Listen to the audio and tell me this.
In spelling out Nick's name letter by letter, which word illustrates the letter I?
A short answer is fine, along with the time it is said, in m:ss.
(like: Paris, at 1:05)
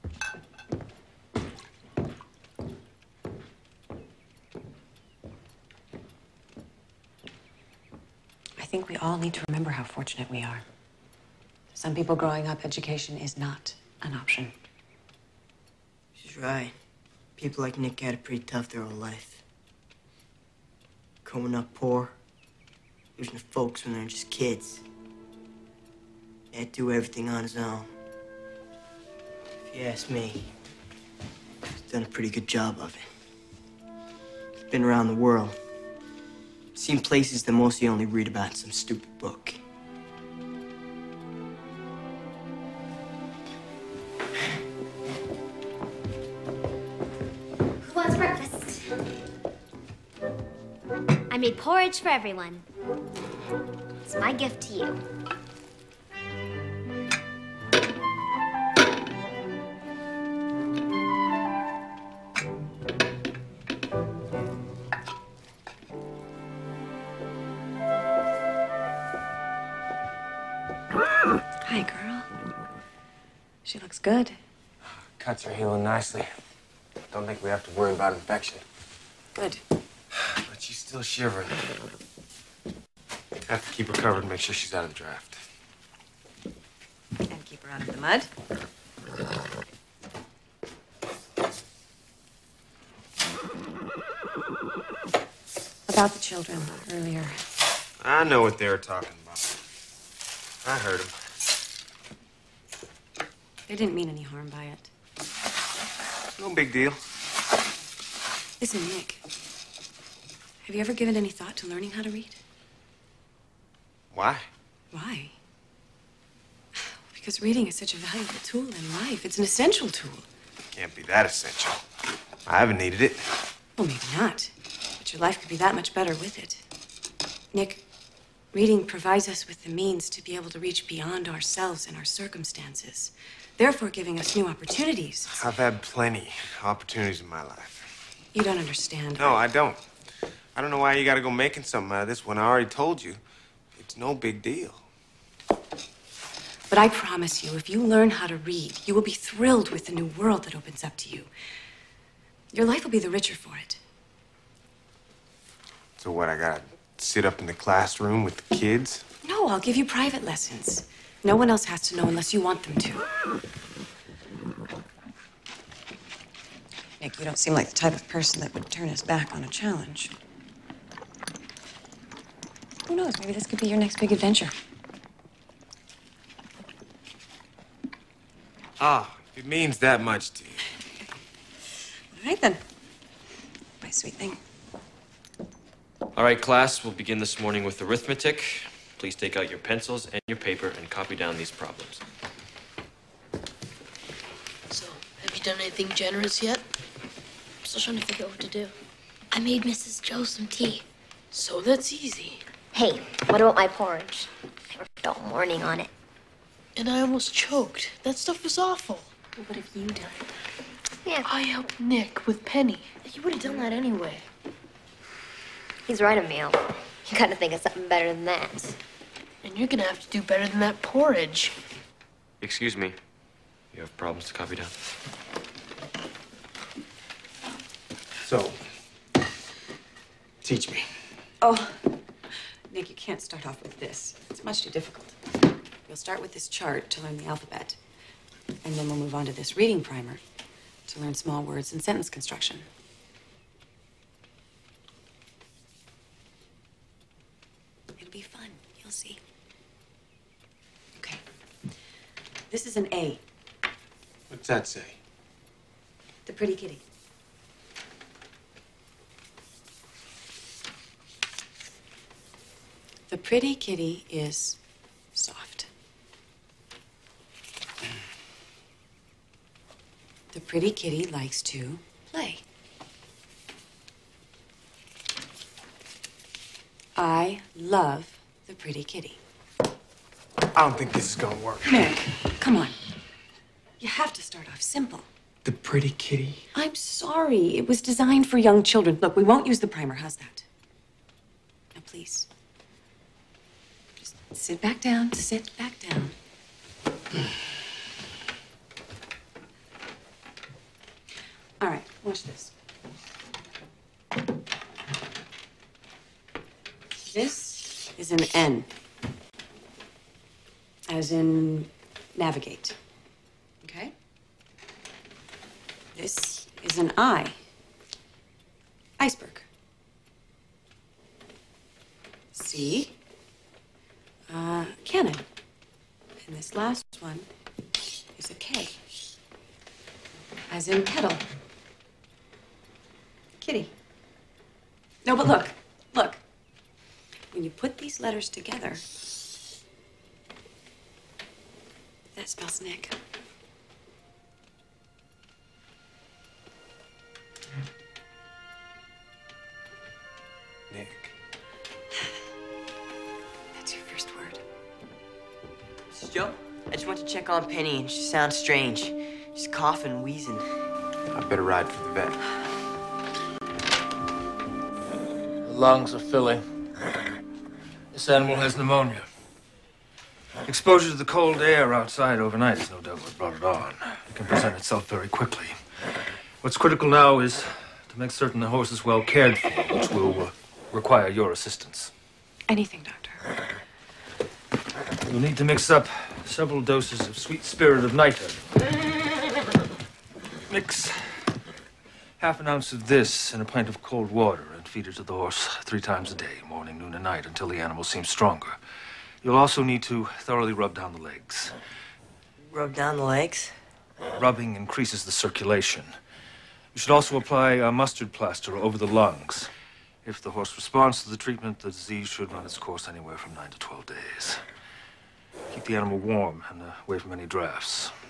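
iceberg, at 5:18.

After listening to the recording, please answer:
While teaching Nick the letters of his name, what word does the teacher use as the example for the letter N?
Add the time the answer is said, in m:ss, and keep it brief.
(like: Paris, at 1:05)
navigate, at 5:12.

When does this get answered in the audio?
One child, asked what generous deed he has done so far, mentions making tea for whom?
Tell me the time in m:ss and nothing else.
3:19.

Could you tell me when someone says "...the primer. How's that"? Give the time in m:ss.
4:49.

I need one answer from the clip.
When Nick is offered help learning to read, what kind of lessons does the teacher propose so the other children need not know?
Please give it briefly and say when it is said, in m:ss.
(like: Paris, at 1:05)
private lessons, at 2:39.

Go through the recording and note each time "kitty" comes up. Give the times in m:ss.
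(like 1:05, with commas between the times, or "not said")
4:16, 4:23, 4:30, 4:38, 4:45, 5:33.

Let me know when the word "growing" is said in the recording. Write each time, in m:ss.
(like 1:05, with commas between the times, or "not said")
0:12, 0:21.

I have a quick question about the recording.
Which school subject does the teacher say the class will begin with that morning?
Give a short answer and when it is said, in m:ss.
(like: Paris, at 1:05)
arithmetic, at 3:07.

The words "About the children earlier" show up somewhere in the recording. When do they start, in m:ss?
1:35.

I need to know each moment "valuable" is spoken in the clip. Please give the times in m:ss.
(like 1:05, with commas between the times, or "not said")
1:57.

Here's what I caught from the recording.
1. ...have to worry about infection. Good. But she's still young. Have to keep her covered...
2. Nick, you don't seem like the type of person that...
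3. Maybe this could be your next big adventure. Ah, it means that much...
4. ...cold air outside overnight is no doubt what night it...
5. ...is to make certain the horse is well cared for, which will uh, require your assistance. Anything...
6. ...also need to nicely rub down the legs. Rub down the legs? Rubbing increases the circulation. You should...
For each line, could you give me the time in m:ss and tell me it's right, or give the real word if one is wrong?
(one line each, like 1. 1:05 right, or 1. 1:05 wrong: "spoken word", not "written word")
1. 1:17 wrong: "shivering", not "young"
2. 2:46 right
3. 2:53 right
4. 6:11 wrong: "brought", not "night"
5. 6:17 right
6. 6:39 wrong: "thoroughly", not "nicely".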